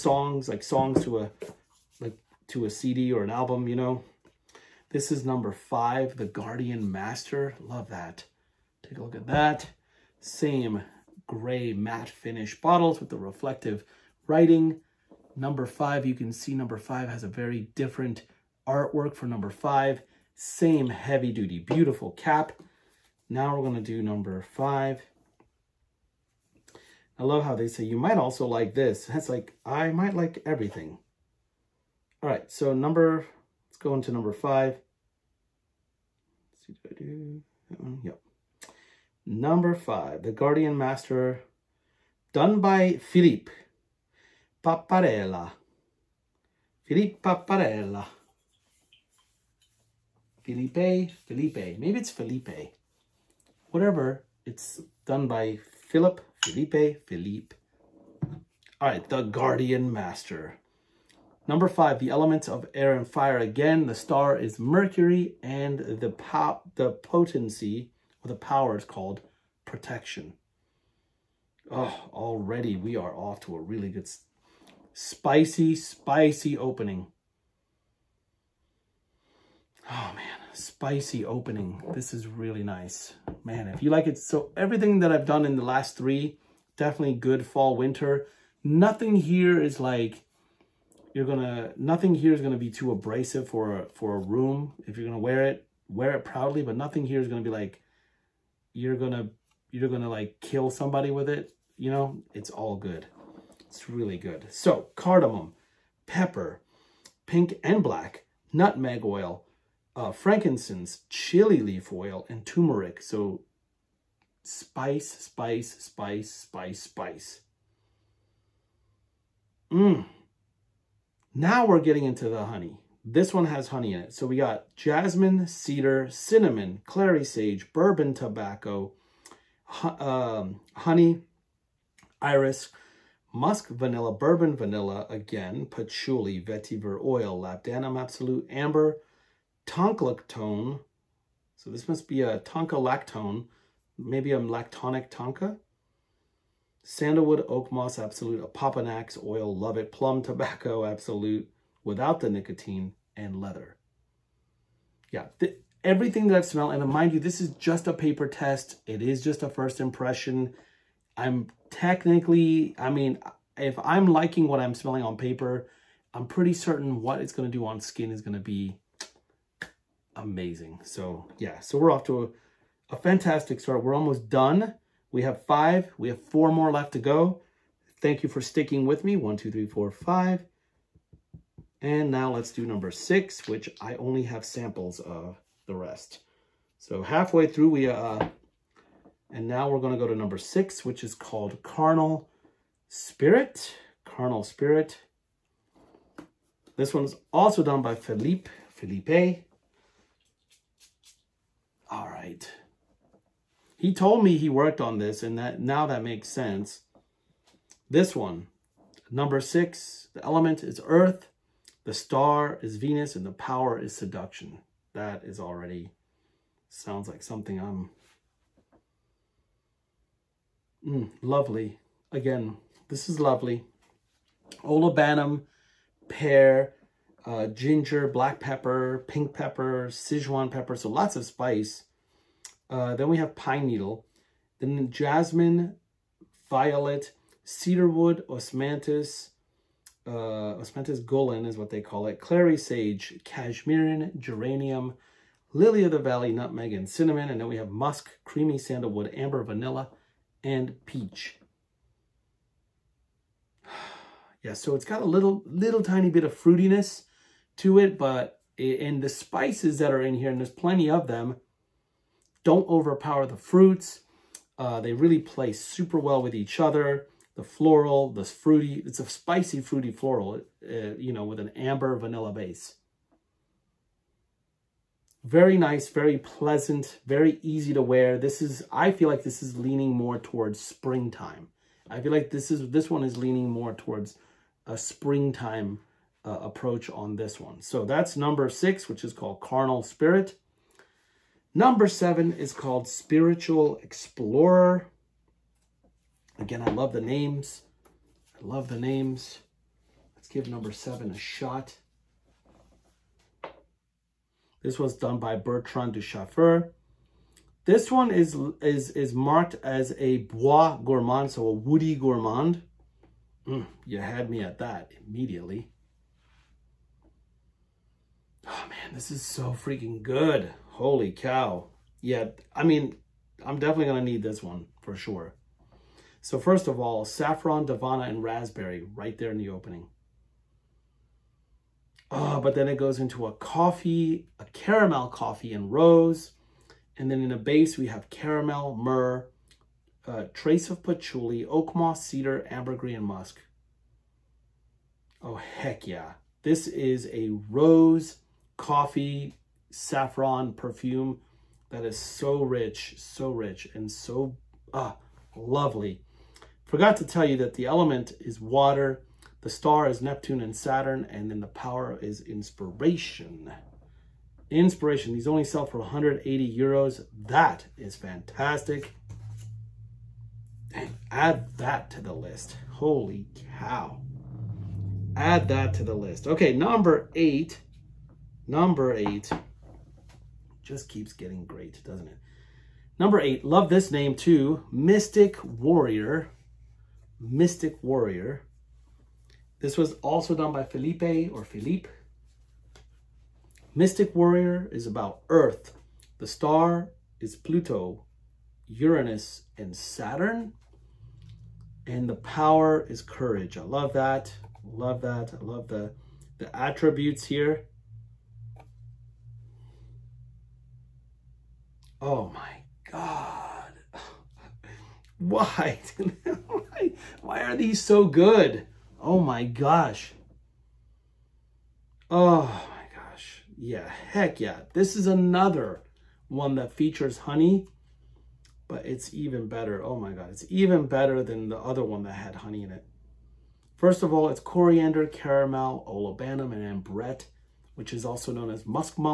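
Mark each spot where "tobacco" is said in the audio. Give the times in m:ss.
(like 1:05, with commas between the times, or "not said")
2:08, 2:30.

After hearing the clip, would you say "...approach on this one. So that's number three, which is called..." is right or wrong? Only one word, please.
wrong.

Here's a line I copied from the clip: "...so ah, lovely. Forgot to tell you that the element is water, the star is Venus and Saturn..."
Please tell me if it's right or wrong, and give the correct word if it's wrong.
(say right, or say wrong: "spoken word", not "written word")
wrong: "Neptune", not "Venus".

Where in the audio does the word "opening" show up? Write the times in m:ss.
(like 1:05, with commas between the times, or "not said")
1:16, 1:21, 5:29.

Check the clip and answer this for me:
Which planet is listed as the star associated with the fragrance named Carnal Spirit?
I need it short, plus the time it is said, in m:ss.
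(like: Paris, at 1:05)
Venus, at 3:31.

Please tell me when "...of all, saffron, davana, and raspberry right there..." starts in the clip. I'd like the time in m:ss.
5:26.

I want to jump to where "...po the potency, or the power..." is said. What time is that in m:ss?
1:06.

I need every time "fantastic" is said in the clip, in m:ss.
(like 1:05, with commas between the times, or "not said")
2:52, 6:07.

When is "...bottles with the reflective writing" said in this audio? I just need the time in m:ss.
0:12.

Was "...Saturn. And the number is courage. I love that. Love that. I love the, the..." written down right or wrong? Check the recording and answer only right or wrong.
wrong.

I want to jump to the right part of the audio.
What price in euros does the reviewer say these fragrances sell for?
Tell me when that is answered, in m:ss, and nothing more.
6:05.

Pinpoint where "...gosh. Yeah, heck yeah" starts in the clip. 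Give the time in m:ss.
7:02.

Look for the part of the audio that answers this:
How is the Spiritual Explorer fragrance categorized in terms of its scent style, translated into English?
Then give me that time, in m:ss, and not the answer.
5:11.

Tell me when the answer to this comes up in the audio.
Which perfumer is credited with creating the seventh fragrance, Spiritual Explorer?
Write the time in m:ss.
5:05.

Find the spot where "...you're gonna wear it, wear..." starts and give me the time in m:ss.
1:34.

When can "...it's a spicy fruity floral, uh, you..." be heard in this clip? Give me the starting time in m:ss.
4:28.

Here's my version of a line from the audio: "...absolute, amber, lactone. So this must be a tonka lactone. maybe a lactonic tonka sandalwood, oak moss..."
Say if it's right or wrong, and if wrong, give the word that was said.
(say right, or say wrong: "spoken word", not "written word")
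right.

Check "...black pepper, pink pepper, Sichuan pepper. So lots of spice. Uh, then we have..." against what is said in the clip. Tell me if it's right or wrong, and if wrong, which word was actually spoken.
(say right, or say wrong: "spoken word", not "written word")
right.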